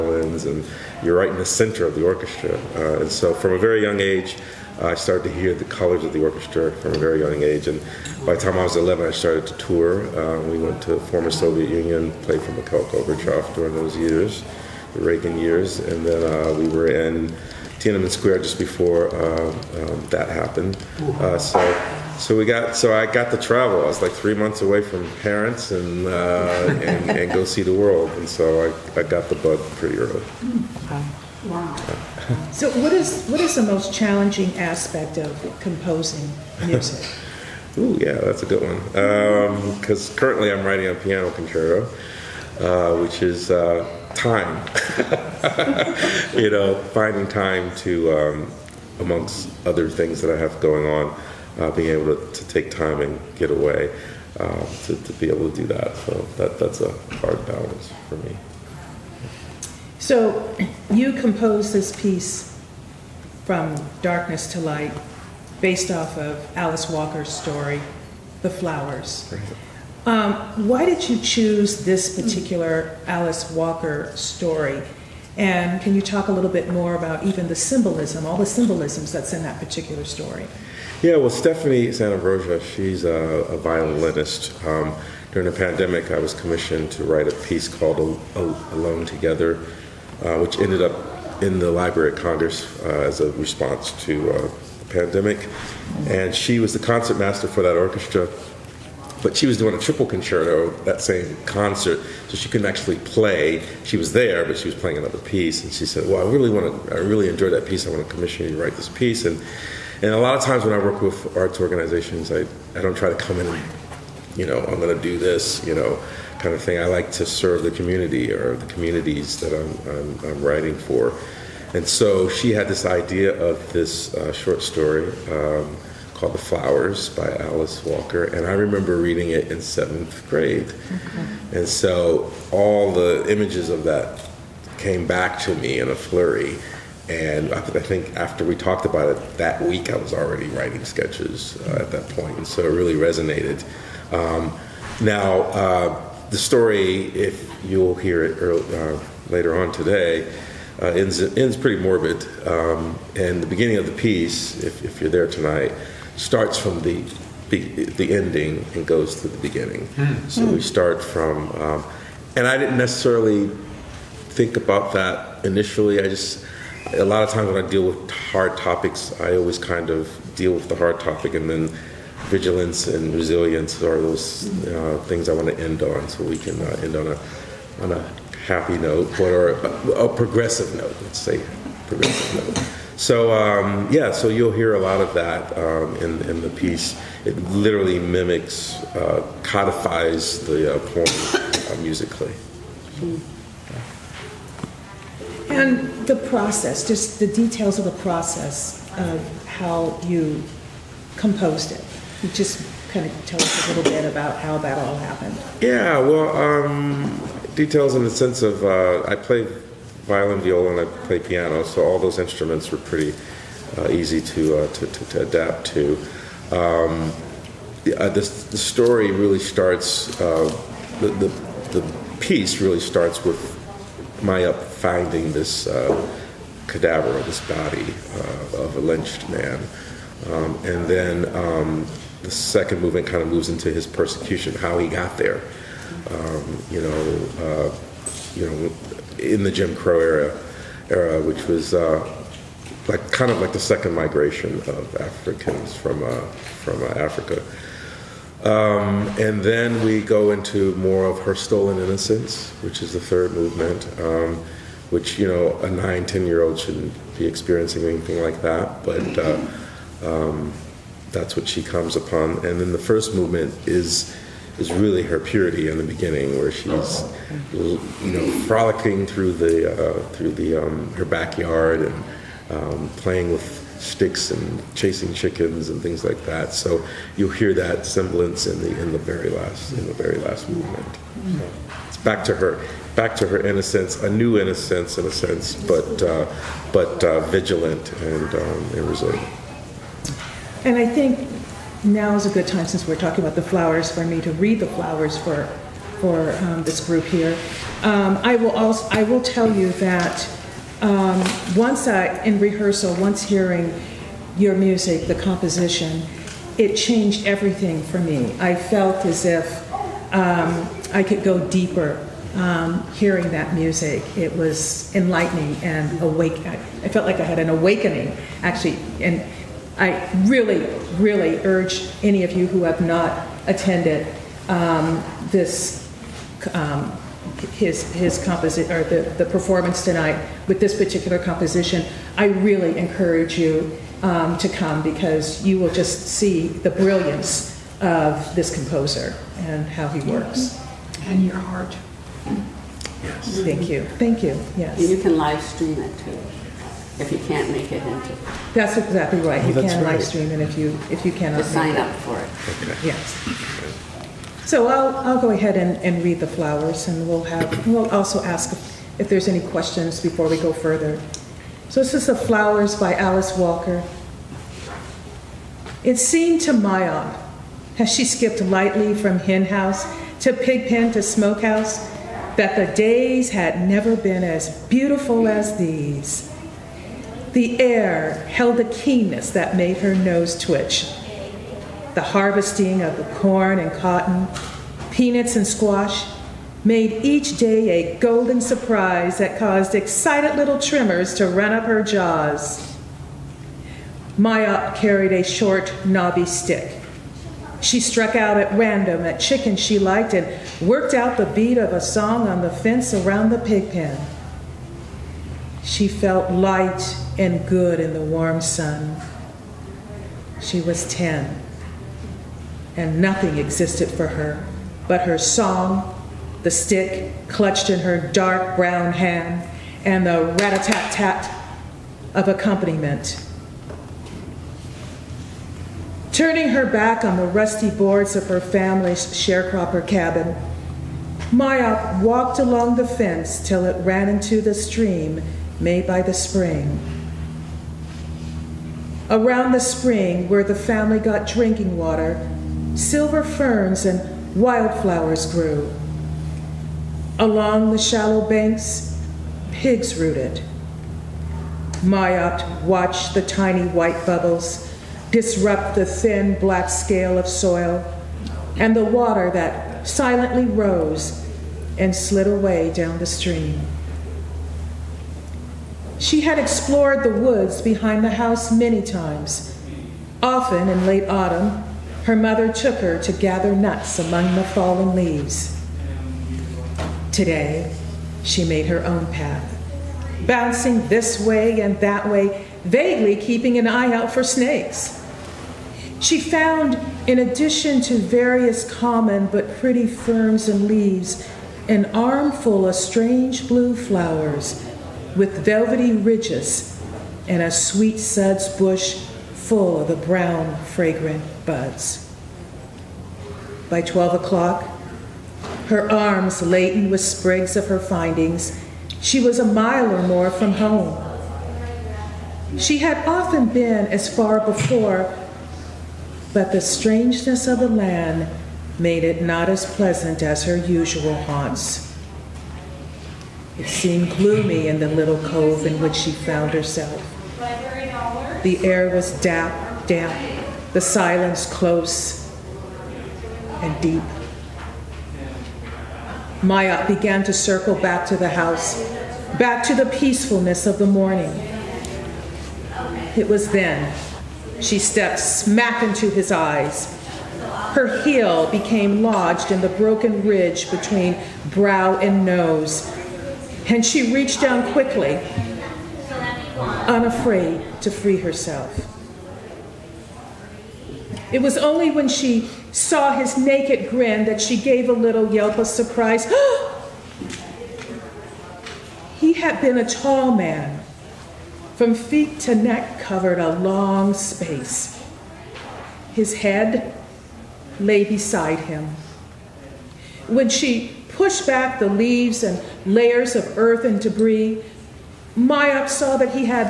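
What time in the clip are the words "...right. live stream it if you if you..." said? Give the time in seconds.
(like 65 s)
349 s.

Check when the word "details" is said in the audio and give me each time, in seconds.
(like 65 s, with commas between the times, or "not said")
197 s, 207 s.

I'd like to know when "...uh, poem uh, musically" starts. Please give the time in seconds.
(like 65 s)
190 s.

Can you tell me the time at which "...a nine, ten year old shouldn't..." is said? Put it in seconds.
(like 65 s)
255 s.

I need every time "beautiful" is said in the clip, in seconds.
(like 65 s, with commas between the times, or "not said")
374 s.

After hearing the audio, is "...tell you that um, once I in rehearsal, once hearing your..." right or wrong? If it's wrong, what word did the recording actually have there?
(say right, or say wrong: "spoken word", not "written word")
right.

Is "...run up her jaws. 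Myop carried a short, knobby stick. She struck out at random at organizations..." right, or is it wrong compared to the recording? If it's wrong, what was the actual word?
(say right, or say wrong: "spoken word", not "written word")
wrong: "chickens", not "organizations".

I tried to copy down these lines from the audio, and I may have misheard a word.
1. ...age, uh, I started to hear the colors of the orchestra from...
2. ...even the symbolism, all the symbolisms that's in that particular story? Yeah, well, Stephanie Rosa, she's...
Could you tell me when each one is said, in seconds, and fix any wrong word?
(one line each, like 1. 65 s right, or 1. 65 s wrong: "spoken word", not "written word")
1. 3 s right
2. 77 s right.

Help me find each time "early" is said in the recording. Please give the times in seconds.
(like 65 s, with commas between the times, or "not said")
29 s, 148 s.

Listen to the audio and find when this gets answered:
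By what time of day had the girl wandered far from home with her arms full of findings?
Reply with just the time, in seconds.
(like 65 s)
503 s.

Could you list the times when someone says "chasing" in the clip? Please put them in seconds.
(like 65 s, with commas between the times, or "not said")
274 s.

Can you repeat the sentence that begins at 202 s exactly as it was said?
just kind of tell us a little bit about how that all happened.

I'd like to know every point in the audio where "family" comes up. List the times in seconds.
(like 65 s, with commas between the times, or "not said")
428 s, 440 s.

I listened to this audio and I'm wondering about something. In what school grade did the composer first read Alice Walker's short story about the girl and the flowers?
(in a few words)
Seventh grade.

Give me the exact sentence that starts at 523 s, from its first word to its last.
It seemed gloomy in the little cove in which she found herself.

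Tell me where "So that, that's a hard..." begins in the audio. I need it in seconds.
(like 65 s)
55 s.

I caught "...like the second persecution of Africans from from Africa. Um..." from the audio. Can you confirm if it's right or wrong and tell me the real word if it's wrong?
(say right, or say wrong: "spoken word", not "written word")
wrong: "migration", not "persecution".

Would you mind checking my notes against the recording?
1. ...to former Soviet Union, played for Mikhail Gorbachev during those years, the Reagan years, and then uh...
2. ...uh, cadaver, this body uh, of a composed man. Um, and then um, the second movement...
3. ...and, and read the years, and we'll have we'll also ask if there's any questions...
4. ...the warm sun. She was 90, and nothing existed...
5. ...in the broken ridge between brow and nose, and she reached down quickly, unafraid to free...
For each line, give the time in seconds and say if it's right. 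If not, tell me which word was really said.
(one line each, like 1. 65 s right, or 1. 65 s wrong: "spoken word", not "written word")
1. 10 s right
2. 225 s wrong: "lynched", not "composed"
3. 355 s wrong: "flowers", not "years"
4. 407 s wrong: "10", not "90"
5. 549 s right.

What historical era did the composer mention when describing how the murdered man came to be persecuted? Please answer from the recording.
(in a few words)
Jim Crow era.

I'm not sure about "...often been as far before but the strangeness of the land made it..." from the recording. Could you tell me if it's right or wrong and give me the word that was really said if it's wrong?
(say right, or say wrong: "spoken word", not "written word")
right.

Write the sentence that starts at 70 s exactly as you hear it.
Um, why did you choose this particular Alice Walker story?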